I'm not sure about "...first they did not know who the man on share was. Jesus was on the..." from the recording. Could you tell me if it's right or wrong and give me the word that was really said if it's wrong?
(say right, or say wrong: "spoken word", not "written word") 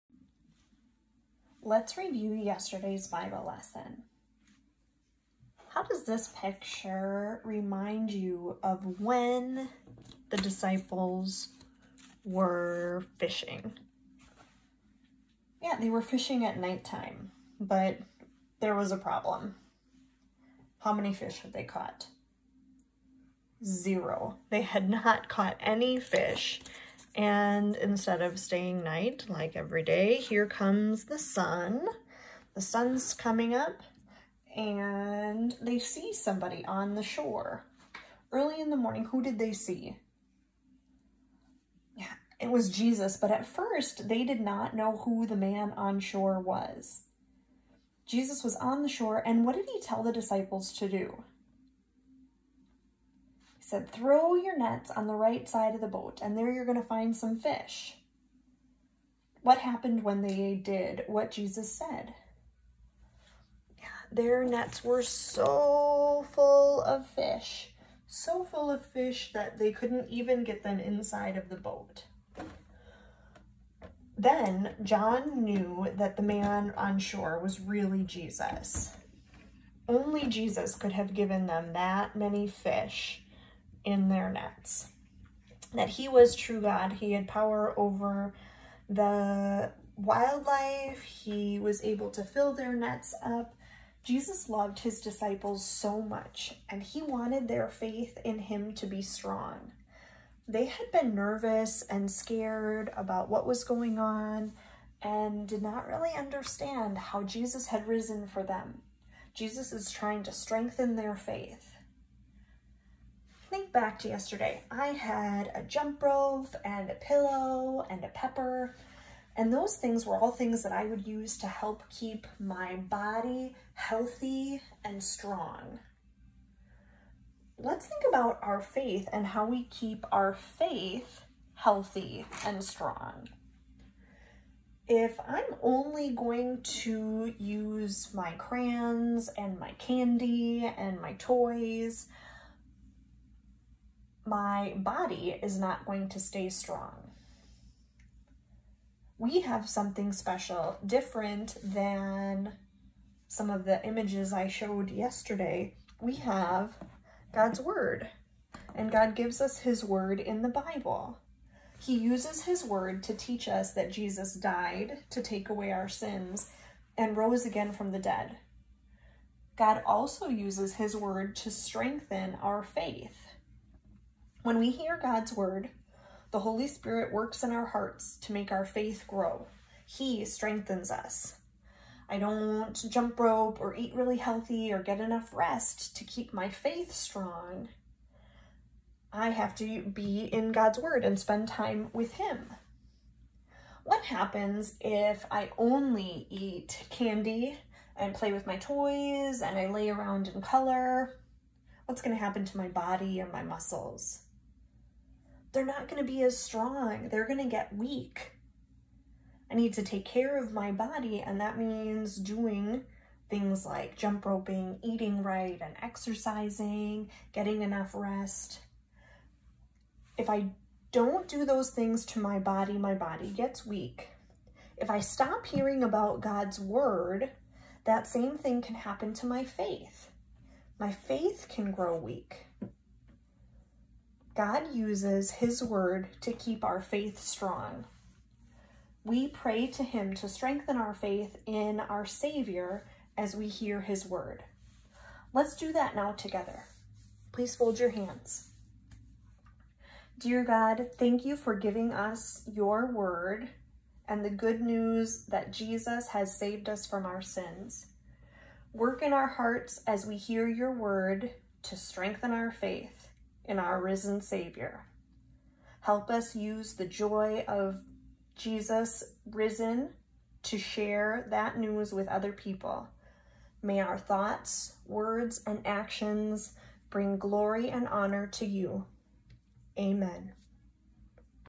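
wrong: "shore", not "share".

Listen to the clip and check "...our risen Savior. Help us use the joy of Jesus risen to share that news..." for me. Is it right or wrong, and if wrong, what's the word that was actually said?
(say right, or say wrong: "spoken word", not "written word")
right.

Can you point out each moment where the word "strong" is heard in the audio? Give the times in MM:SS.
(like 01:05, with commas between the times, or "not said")
01:39, 02:05, 02:12, 02:26, 03:06, 03:26, 03:57.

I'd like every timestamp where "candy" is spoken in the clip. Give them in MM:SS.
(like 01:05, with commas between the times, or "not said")
02:19, 03:16.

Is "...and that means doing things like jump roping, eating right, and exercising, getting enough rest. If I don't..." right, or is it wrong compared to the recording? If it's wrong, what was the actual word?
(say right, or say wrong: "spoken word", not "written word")
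right.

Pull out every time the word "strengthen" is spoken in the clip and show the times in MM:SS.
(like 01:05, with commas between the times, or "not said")
01:50, 02:51, 03:00, 04:00, 04:21.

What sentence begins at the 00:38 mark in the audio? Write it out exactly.
Early in the morning, who did they see?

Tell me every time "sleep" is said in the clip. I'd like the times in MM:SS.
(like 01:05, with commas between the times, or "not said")
not said.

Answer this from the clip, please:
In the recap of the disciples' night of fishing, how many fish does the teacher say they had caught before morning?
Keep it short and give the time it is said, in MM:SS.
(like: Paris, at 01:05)
0, at 00:23.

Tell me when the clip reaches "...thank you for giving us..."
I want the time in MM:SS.
04:10.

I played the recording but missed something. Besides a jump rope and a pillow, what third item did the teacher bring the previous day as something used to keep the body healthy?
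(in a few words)
A pepper.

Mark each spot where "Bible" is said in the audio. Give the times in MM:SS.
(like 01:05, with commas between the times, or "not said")
00:03, 02:40.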